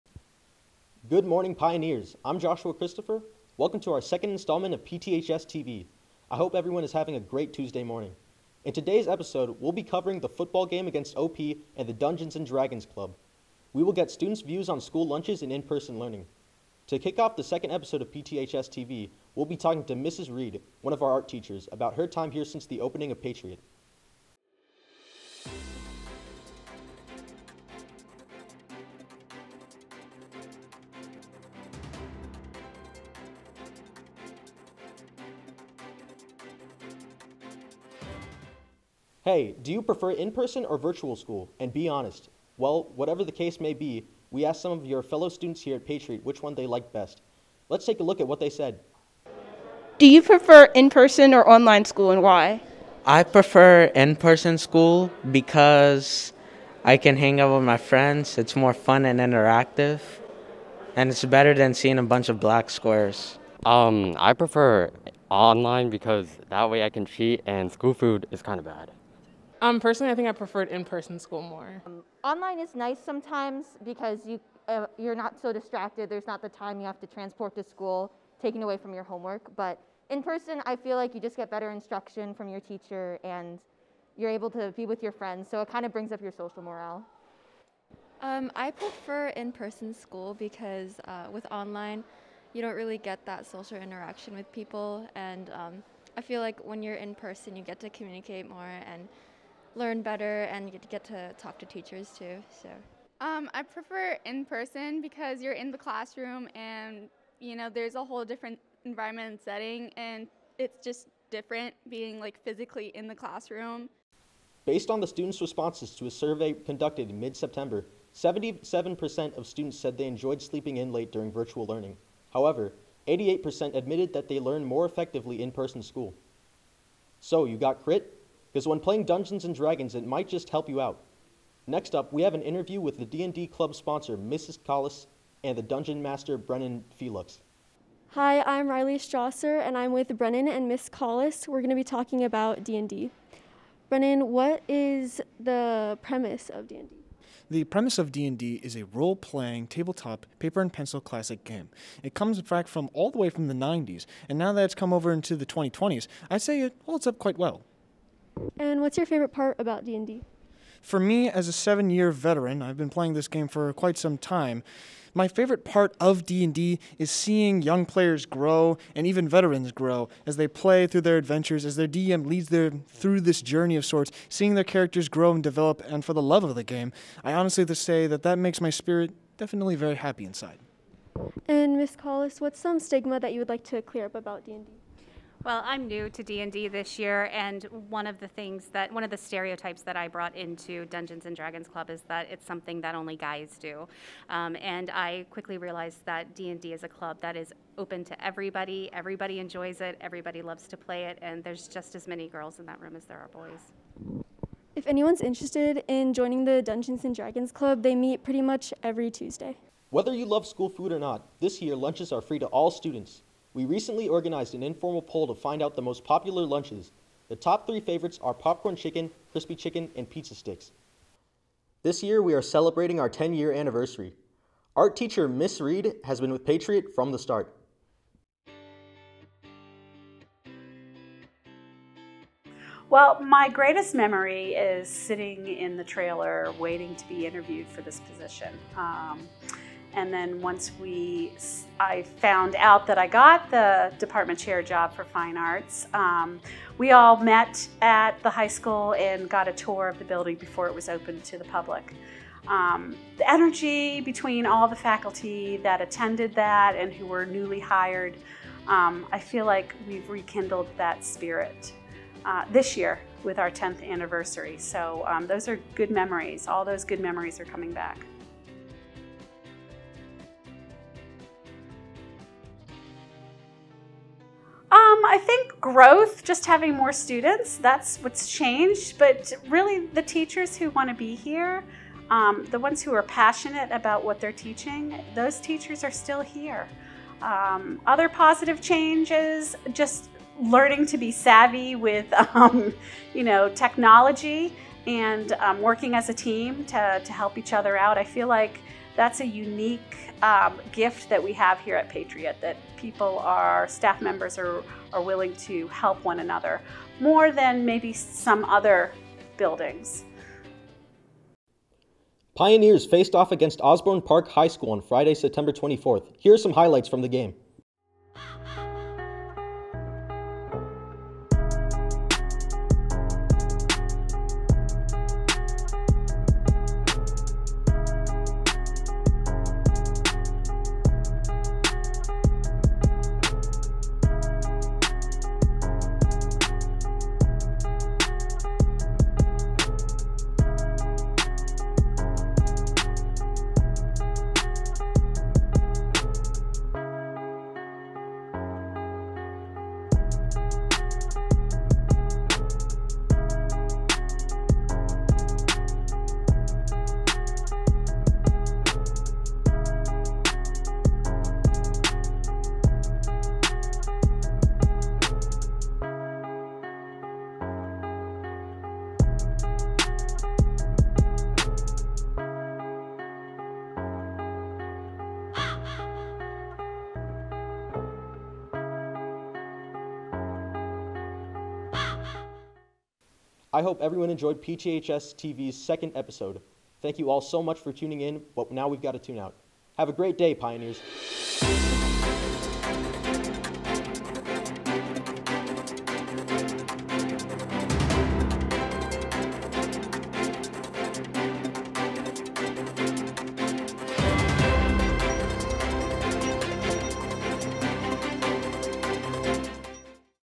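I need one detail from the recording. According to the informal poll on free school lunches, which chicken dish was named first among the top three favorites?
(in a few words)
Popcorn chicken.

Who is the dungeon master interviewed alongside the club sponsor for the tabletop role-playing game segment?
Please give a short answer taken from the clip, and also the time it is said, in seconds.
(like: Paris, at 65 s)
Brennan Felix, at 136 s.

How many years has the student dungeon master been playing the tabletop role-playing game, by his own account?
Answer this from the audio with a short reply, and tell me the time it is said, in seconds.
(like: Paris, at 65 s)
7, at 161 s.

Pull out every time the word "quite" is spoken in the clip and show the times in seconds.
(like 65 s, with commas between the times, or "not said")
157 s, 163 s.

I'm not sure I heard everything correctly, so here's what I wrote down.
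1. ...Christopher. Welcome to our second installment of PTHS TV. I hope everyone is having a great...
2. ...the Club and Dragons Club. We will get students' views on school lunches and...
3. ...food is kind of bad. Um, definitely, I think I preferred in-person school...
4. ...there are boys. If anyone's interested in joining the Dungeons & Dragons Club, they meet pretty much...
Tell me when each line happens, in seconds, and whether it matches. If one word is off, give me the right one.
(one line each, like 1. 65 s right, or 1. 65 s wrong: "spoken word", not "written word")
1. 2 s right
2. 11 s wrong: "Dungeons", not "Club"
3. 67 s wrong: "personally", not "definitely"
4. 203 s right.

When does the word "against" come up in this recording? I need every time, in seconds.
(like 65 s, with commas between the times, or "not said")
10 s, 313 s.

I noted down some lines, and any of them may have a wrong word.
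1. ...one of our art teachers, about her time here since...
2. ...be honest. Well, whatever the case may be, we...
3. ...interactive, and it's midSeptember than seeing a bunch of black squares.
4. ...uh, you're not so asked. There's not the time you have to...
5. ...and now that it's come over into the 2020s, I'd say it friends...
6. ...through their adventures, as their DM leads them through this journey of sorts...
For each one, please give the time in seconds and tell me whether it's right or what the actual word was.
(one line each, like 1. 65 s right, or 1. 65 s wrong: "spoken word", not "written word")
1. 20 s right
2. 41 s right
3. 59 s wrong: "better", not "midSeptember"
4. 74 s wrong: "distracted", not "asked"
5. 154 s wrong: "holds", not "friends"
6. 170 s right.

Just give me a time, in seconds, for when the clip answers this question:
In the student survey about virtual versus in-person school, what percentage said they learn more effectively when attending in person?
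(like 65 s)
123 s.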